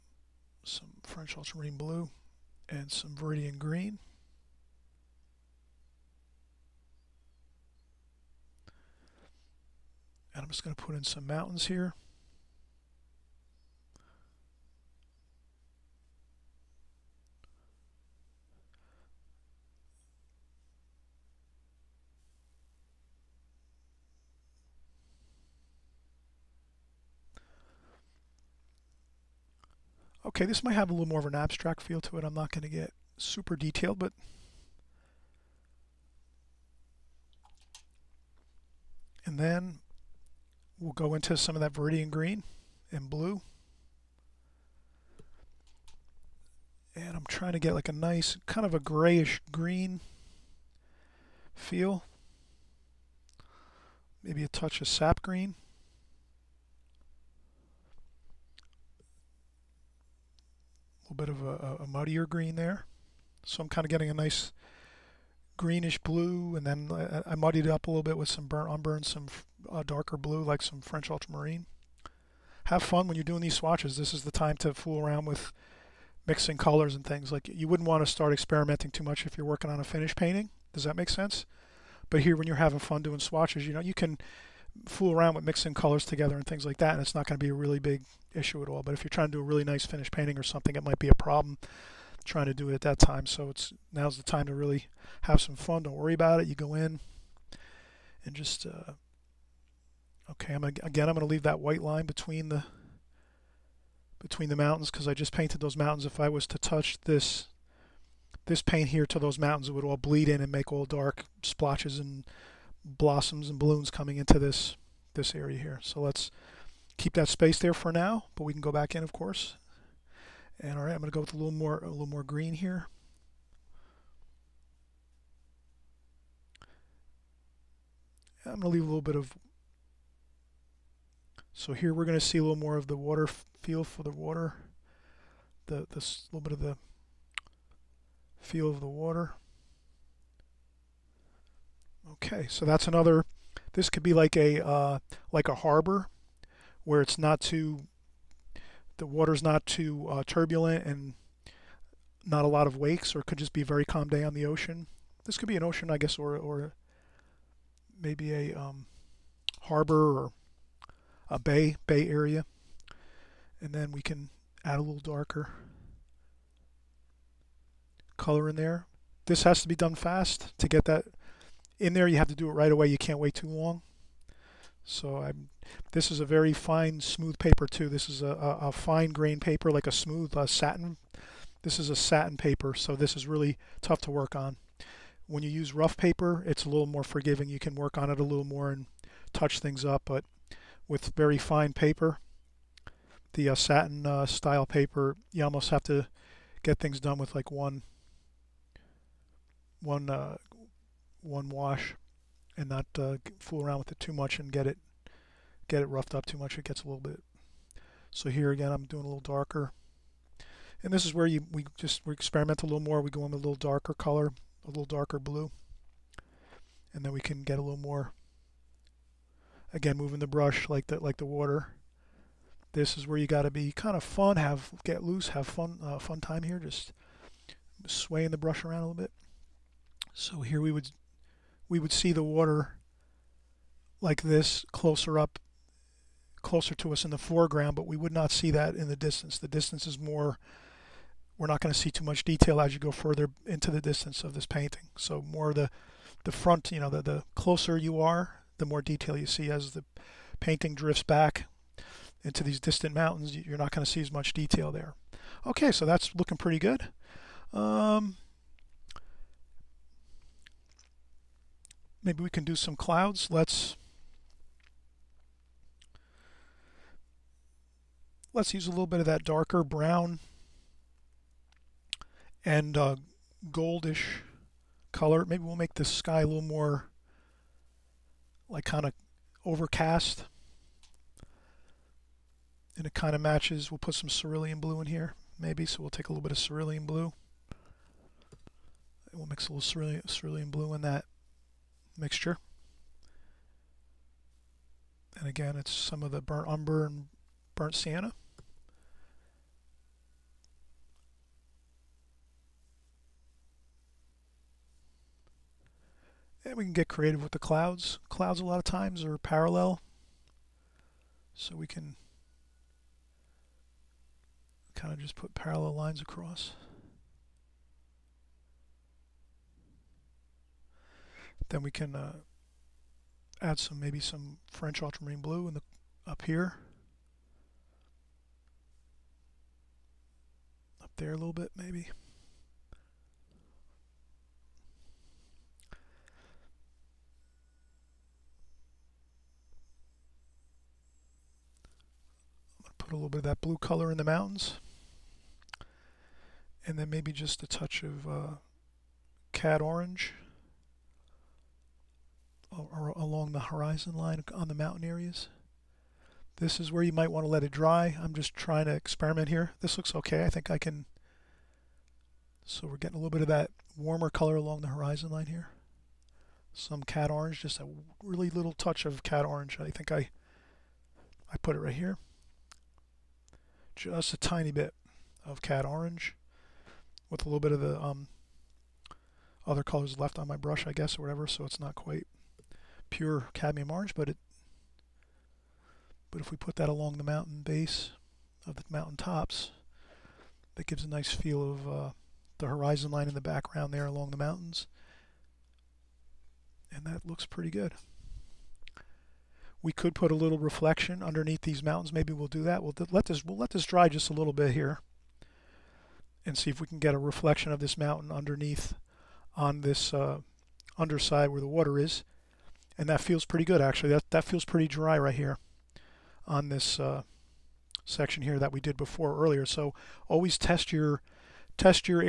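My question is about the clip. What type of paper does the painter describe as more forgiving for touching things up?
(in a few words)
Rough paper.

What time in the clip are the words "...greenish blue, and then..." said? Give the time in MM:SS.
01:05.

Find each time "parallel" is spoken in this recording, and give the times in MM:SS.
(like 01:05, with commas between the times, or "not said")
05:09, 05:15.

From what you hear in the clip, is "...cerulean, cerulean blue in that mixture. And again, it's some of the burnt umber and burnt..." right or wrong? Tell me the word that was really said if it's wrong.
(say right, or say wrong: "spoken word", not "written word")
right.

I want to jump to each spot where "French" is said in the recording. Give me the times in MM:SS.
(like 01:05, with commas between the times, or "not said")
00:01, 01:10, 05:24.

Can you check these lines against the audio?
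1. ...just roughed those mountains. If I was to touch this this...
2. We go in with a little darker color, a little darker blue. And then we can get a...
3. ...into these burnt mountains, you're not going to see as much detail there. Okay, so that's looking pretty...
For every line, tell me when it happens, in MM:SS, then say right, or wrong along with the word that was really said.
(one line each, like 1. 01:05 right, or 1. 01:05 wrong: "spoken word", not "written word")
1. 01:45 wrong: "painted", not "roughed"
2. 03:32 right
3. 04:12 wrong: "distant", not "burnt".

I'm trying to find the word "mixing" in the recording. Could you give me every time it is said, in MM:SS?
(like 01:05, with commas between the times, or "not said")
01:16, 01:25.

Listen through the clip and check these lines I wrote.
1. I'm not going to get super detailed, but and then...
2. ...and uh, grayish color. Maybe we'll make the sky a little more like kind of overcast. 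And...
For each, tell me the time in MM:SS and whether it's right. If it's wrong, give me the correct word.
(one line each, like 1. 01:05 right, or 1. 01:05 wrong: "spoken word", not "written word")
1. 00:32 right
2. 04:32 wrong: "goldish", not "grayish".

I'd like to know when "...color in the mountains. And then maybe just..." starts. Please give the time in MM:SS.
05:43.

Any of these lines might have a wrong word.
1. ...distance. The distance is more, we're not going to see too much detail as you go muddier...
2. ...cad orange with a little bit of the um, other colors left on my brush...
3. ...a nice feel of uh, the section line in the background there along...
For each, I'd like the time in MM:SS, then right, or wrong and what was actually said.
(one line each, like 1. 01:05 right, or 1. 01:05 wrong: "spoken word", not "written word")
1. 03:58 wrong: "further", not "muddier"
2. 06:15 right
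3. 06:30 wrong: "horizon", not "section".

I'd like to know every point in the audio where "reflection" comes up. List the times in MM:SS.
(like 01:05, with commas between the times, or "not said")
06:40, 06:46.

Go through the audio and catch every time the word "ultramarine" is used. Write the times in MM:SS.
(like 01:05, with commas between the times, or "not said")
00:01, 01:11, 05:24.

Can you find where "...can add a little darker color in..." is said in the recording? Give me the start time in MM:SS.
02:44.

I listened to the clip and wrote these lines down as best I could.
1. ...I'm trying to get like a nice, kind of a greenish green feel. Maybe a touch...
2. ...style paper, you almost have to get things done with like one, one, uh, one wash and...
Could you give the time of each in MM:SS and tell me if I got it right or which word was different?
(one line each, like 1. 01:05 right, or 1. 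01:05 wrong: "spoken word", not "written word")
1. 00:47 wrong: "grayish", not "greenish"
2. 03:14 right.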